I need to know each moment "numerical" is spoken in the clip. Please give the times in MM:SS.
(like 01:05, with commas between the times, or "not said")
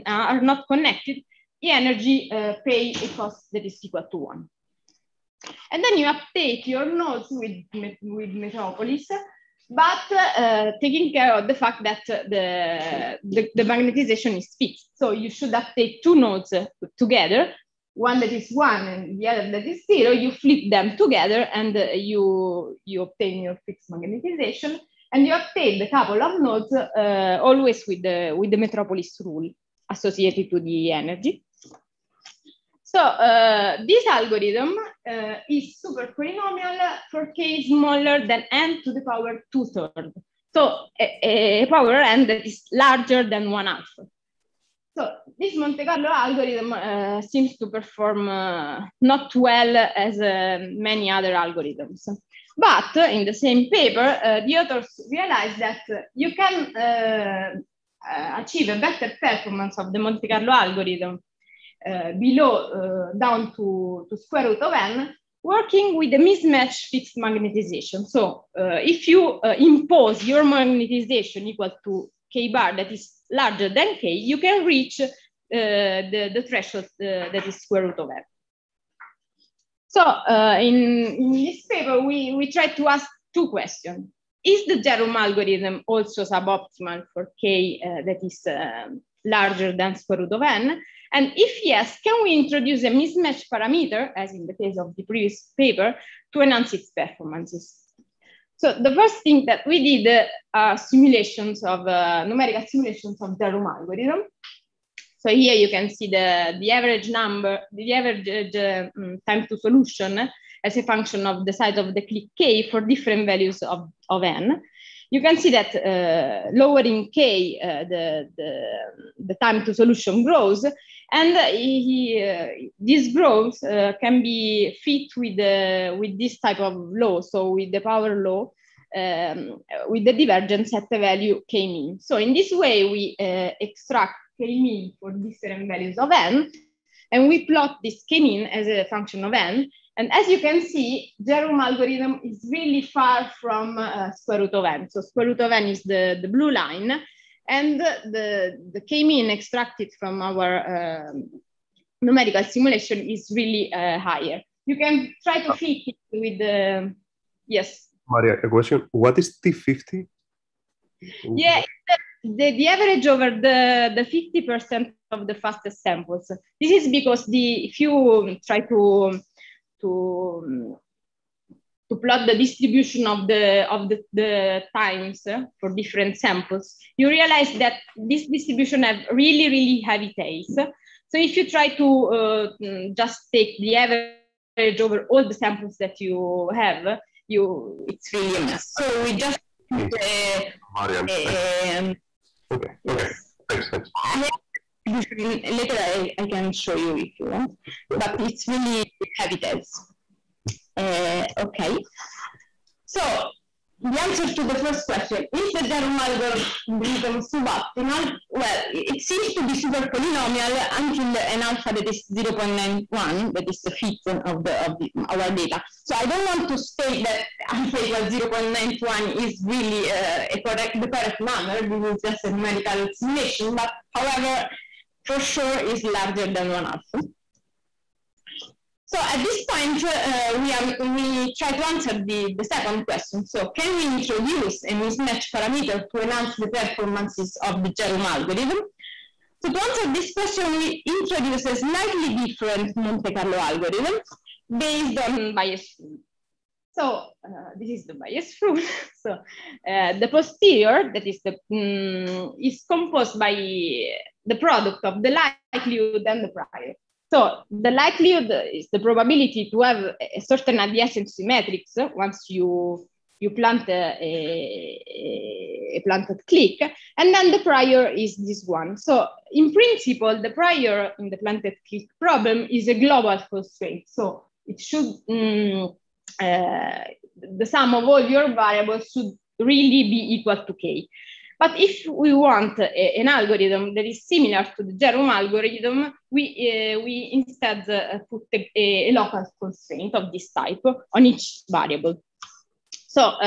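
01:42, 02:31, 03:42.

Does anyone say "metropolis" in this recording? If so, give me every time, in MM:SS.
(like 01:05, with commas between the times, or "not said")
00:08, 00:28.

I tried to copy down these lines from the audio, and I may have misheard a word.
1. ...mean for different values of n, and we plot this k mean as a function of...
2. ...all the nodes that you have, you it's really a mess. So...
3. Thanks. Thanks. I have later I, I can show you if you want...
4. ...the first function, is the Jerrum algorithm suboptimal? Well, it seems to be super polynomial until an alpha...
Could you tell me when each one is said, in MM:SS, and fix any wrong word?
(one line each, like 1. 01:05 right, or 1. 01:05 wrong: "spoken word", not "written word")
1. 02:14 right
2. 03:05 wrong: "samples", not "nodes"
3. 03:13 right
4. 03:24 wrong: "question", not "function".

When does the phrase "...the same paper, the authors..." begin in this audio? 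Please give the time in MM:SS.
00:53.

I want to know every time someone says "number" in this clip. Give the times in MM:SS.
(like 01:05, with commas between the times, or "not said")
01:47, 03:41.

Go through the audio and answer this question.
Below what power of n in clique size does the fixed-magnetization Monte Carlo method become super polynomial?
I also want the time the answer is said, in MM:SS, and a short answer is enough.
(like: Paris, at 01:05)
n to the power 2/3, at 00:38.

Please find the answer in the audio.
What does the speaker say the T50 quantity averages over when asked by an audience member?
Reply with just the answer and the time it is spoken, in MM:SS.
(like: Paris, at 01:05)
the 50% fastest samples, at 02:43.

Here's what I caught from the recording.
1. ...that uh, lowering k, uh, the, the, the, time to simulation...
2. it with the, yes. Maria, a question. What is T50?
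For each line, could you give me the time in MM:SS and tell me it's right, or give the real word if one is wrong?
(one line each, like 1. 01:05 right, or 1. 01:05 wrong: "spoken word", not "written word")
1. 01:55 wrong: "solution", not "simulation"
2. 02:35 right.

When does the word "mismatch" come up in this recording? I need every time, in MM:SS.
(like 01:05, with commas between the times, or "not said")
01:06, 01:32, 03:54.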